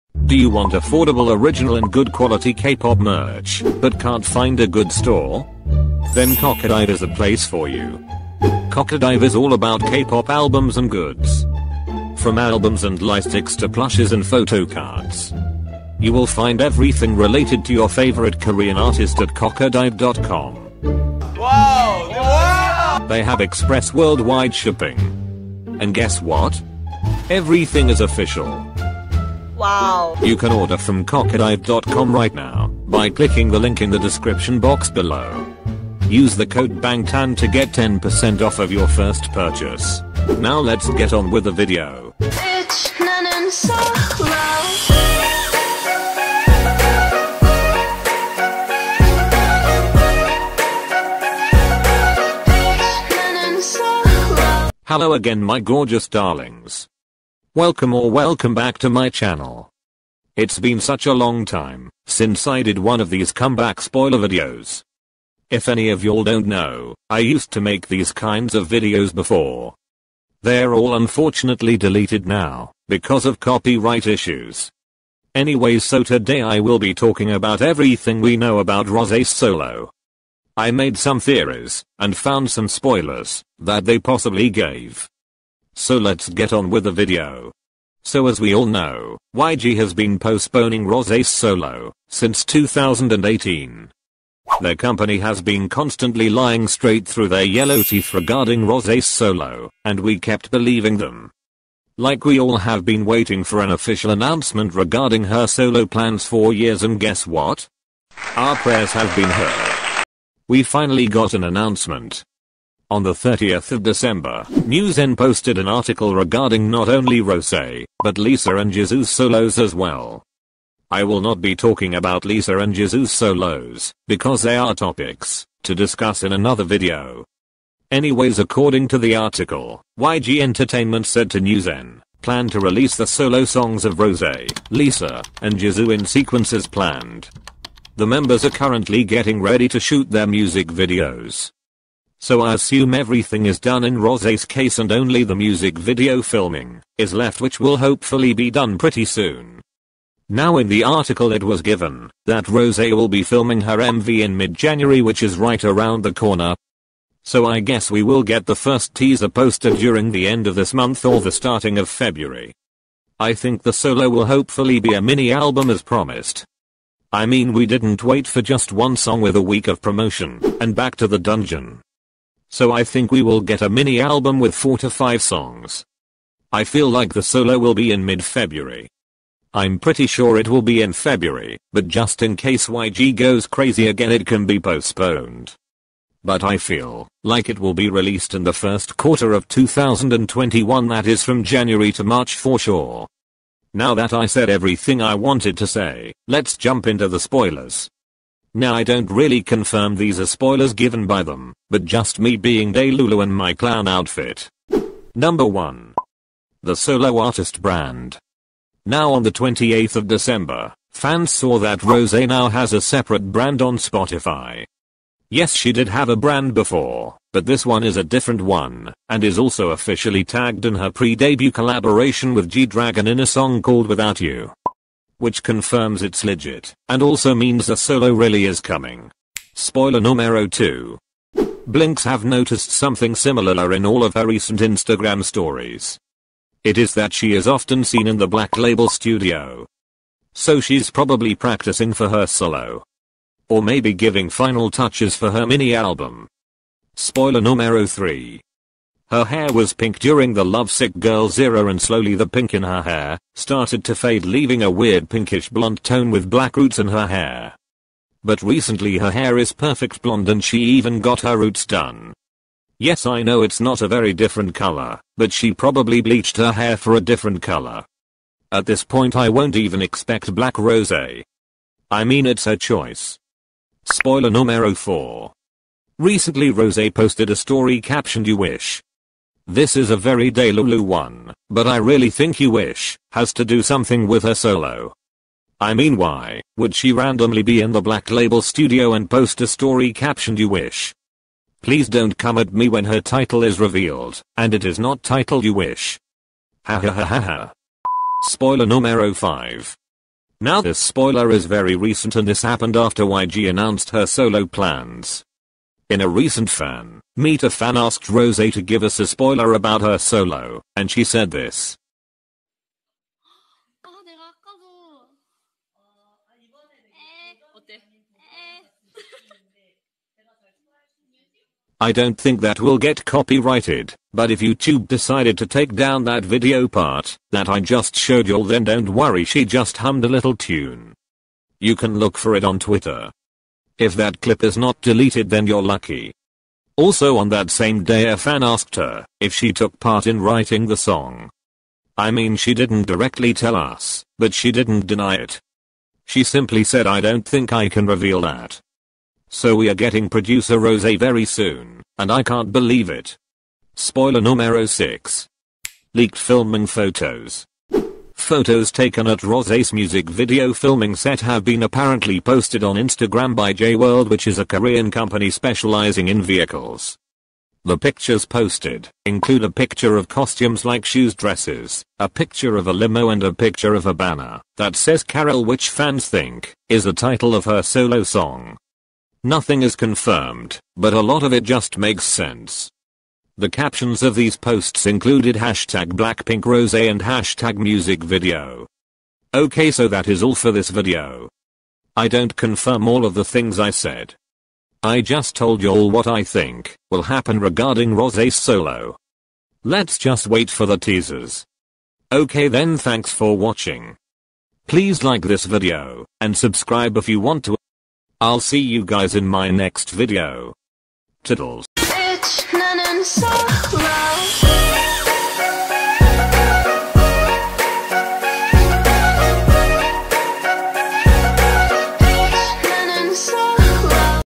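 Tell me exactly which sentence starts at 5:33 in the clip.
If that clip is not deleted then you're lucky.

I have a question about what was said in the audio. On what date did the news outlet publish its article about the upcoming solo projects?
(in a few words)
30th of December.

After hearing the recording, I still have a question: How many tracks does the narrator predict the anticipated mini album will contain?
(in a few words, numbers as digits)
4 to 5.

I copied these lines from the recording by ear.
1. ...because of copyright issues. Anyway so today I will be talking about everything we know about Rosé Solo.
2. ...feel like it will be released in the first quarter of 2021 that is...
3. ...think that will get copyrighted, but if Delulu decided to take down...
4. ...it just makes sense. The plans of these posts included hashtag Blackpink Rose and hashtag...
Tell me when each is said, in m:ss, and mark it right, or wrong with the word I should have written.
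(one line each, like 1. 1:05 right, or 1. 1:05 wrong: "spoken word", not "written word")
1. 1:12 right
2. 3:06 right
3. 5:22 wrong: "YouTube", not "Delulu"
4. 6:21 wrong: "captions", not "plans".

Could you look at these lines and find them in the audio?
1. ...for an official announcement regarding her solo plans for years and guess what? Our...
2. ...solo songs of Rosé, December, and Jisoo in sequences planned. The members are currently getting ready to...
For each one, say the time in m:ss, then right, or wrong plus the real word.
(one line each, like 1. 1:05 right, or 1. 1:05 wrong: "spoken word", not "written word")
1. 1:43 right
2. 2:13 wrong: "Lisa", not "December".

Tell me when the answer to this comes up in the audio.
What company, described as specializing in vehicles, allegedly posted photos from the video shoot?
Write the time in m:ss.
6:03.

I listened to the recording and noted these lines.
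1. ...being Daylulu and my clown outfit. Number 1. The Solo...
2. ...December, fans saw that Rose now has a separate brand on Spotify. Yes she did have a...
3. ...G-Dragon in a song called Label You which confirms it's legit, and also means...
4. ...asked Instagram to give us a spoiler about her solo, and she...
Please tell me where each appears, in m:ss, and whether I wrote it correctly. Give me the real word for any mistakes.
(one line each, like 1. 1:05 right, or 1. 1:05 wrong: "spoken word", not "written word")
1. 3:22 right
2. 3:30 right
3. 3:42 wrong: "Without", not "Label"
4. 5:07 wrong: "Rose", not "Instagram".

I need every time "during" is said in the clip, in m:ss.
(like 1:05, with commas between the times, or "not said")
2:39, 4:09.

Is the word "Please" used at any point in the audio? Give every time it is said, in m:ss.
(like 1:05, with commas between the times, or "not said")
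4:51, 6:44.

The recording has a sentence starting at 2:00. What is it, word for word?
I will not be talking about Lisa and Jisoo's solos, because they are topics to discuss in another video.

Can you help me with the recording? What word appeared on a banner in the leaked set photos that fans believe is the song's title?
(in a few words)
Carol.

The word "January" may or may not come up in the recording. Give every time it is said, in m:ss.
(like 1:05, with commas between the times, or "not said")
2:34, 3:11.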